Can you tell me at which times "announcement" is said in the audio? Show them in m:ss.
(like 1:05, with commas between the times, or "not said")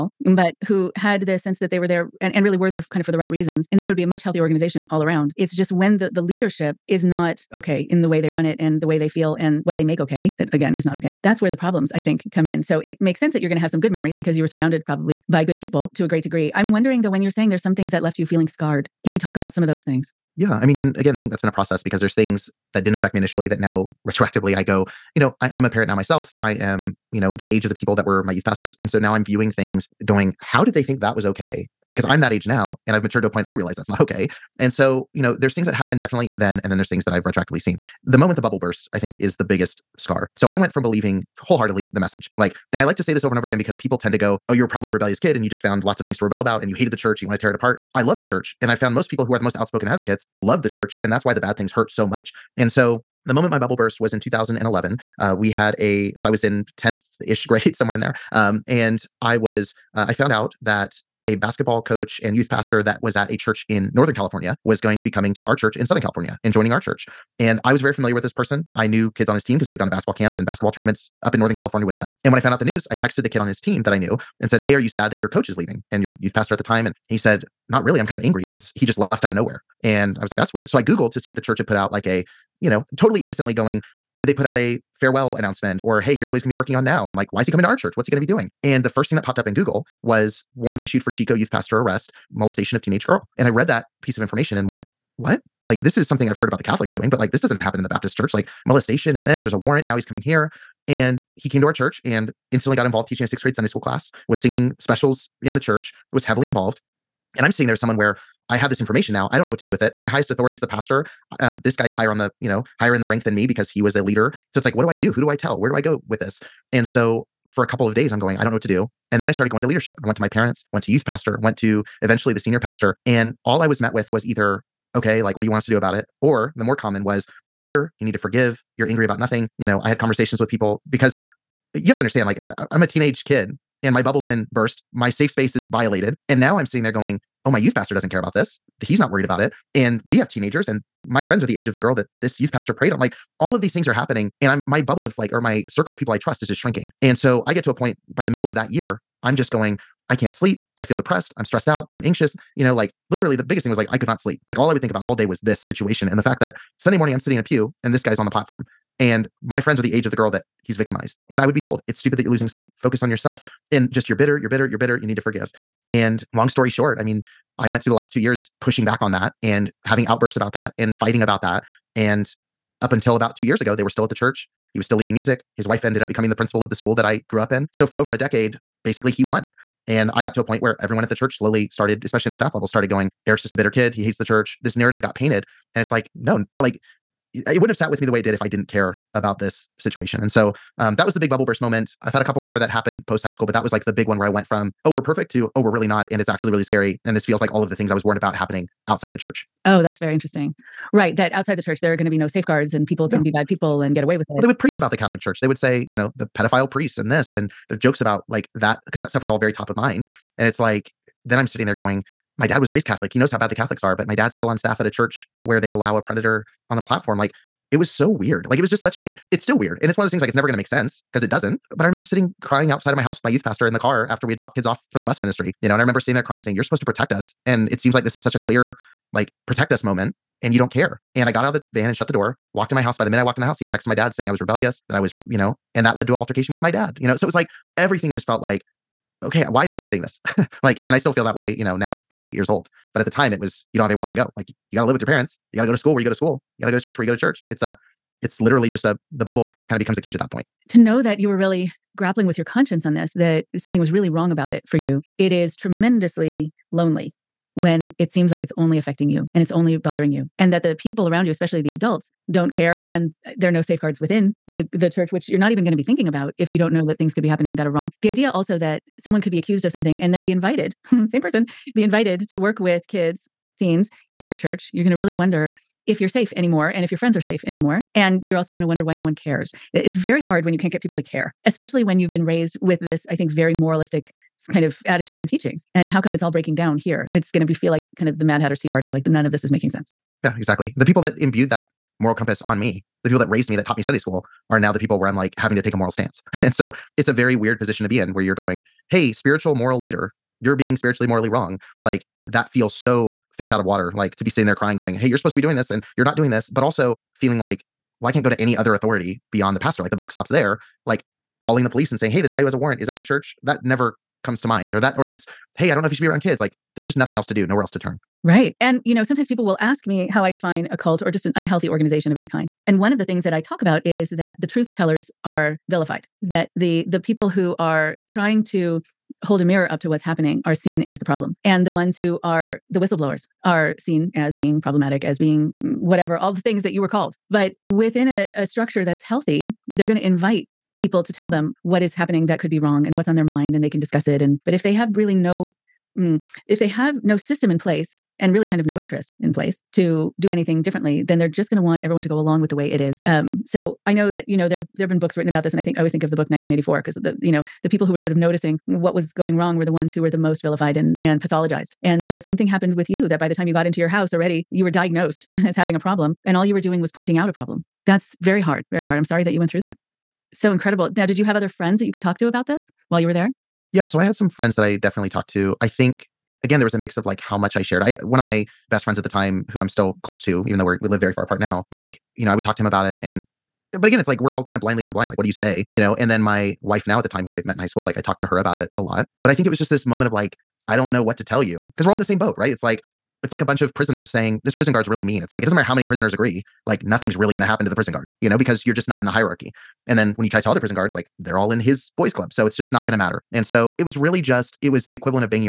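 1:25.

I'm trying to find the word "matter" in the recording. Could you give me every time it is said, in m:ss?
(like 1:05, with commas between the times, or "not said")
6:35, 6:42.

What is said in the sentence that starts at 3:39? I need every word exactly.
And it's one of those things like it's never going to make sense because it doesn't.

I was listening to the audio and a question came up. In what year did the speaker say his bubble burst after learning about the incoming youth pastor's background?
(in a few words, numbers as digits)
2011.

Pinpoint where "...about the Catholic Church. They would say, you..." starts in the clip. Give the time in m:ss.
3:24.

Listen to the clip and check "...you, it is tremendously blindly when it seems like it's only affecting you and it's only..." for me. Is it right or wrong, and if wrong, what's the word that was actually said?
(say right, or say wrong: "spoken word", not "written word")
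wrong: "lonely", not "blindly".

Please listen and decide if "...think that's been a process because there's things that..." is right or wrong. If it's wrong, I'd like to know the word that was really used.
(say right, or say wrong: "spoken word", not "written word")
right.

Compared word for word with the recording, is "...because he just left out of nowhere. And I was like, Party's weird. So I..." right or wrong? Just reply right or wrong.
wrong.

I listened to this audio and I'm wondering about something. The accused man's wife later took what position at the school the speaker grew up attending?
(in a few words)
principal.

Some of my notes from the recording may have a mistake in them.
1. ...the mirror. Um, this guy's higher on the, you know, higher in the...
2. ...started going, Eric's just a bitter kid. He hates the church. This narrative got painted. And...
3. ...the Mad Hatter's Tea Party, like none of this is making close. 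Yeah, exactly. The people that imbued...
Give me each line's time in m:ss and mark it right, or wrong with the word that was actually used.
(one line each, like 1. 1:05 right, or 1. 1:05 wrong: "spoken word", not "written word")
1. 1:50 wrong: "pastor", not "mirror"
2. 3:02 right
3. 4:48 wrong: "sense", not "close".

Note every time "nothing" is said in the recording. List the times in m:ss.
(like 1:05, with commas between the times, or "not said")
2:09, 5:16, 6:36.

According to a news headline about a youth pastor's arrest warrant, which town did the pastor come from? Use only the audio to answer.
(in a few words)
Chico.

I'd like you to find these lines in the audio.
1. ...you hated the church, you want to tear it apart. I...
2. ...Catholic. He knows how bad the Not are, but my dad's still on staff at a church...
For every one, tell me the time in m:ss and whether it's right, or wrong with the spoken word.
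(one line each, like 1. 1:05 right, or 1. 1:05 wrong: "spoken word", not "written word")
1. 0:46 right
2. 3:32 wrong: "Catholics", not "Not".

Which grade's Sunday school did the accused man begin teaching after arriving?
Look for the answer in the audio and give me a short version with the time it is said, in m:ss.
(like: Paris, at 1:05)
sixth grade, at 1:43.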